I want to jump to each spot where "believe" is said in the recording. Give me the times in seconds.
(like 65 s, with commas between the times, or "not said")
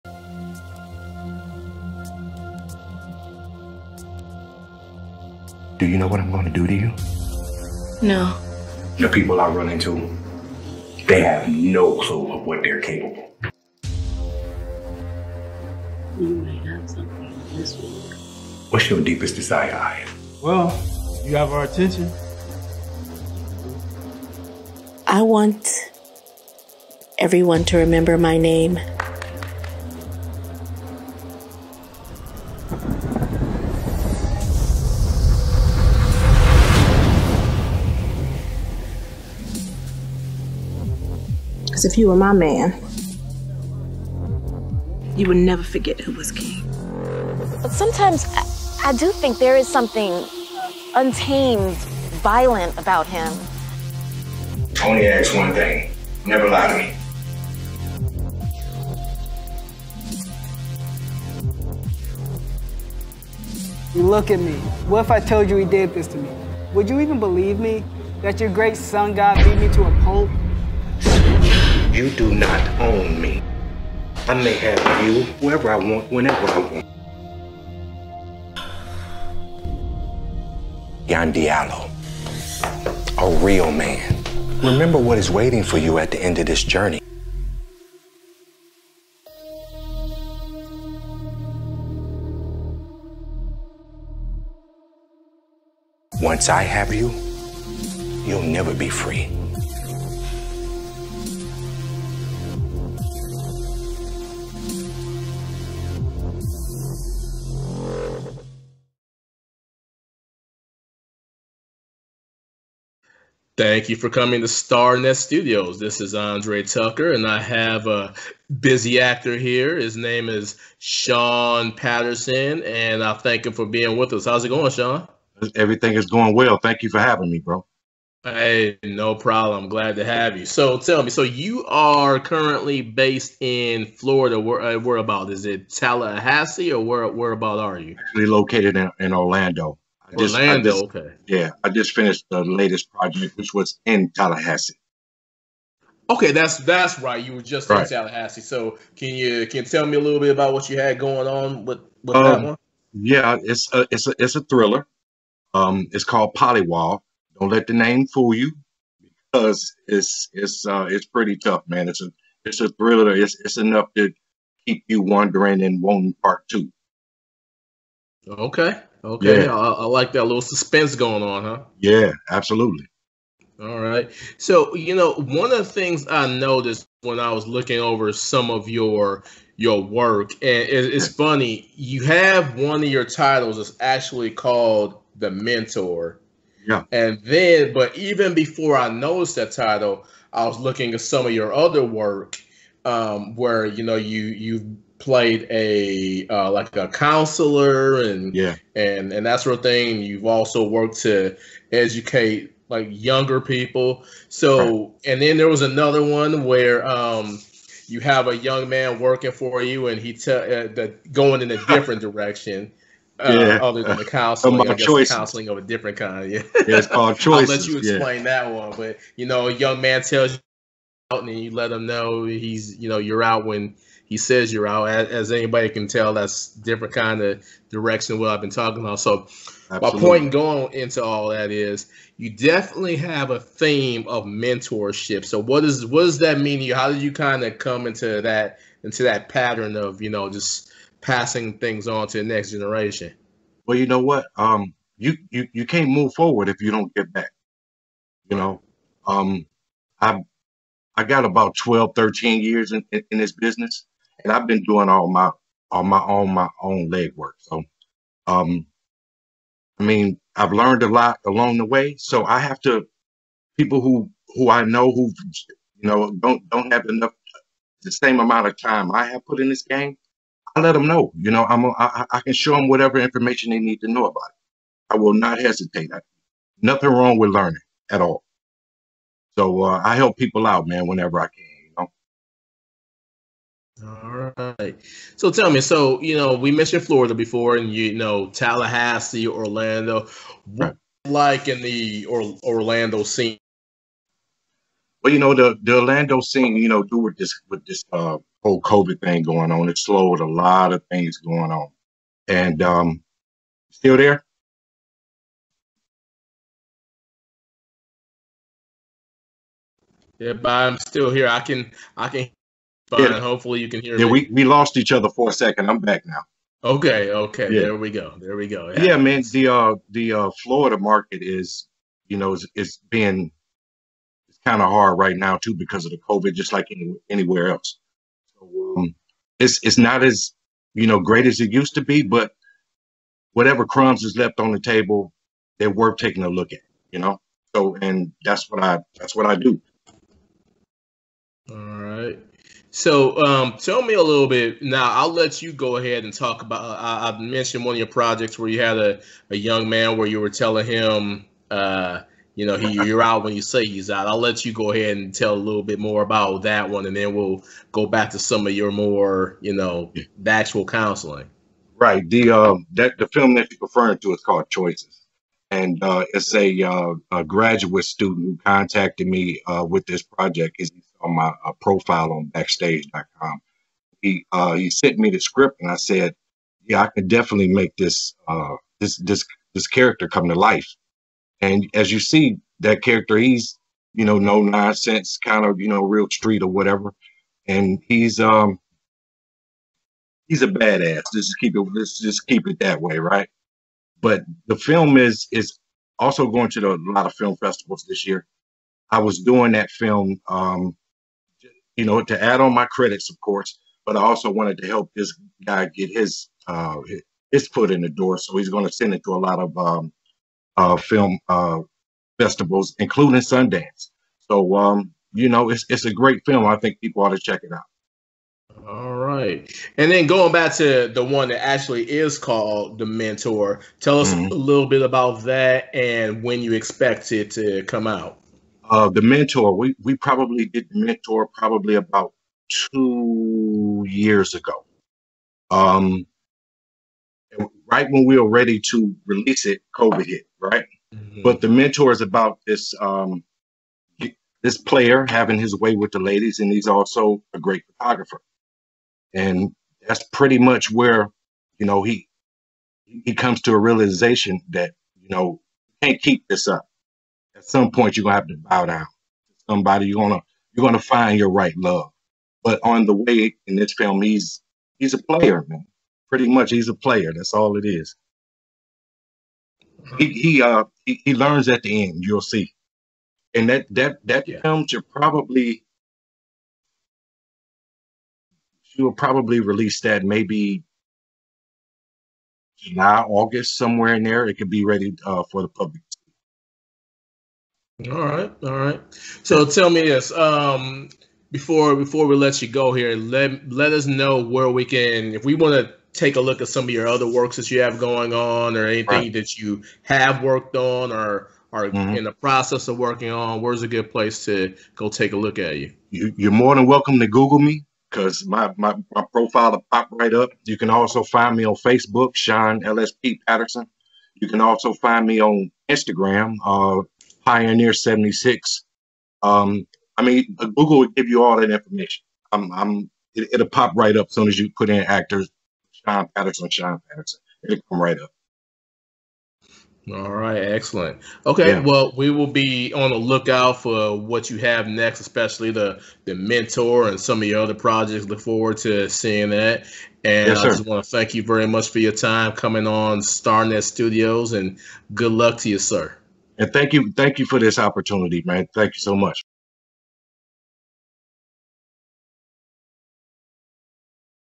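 67 s.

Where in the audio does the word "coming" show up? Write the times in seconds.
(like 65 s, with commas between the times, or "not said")
114 s, 542 s.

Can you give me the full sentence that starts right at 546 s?
And thank you, thank you for this opportunity, man.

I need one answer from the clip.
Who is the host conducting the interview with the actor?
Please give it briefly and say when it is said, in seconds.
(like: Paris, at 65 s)
Andre Tucker, at 116 s.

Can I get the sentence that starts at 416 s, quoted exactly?
I think people ought to check it out.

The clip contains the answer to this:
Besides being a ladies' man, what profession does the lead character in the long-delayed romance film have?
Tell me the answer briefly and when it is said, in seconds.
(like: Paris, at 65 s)
Photographer, at 447 s.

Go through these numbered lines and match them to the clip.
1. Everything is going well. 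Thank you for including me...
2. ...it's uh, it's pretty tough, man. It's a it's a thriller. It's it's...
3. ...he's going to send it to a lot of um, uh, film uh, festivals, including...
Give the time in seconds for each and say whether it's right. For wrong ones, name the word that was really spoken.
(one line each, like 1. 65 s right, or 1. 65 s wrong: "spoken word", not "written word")
1. 125 s wrong: "having", not "including"
2. 160 s right
3. 408 s right.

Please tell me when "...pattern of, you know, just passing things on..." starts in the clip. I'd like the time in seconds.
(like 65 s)
239 s.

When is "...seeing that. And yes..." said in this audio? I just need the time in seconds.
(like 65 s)
538 s.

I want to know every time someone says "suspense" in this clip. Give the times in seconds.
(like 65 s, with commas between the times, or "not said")
170 s.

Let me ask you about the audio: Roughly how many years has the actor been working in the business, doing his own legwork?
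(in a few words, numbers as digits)
12 to 13 years.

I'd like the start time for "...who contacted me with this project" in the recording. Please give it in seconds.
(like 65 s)
368 s.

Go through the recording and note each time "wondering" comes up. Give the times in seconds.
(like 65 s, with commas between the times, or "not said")
165 s.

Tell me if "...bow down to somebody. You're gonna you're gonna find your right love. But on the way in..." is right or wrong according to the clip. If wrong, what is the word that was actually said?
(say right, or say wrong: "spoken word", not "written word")
right.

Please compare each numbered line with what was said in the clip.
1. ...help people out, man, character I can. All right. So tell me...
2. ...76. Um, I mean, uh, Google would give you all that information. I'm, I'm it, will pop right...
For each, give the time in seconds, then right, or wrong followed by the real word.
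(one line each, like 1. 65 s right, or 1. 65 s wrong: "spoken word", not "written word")
1. 279 s wrong: "whenever", not "character"
2. 517 s right.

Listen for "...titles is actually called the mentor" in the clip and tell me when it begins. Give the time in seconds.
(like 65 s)
183 s.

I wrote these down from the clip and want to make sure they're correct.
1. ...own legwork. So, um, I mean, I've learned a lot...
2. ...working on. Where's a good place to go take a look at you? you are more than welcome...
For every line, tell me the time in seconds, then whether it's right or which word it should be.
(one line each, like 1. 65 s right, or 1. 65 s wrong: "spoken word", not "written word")
1. 256 s right
2. 502 s right.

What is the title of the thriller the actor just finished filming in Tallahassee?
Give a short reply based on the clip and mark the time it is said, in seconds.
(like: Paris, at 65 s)
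Polywall, at 156 s.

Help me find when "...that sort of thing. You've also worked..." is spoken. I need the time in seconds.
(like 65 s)
199 s.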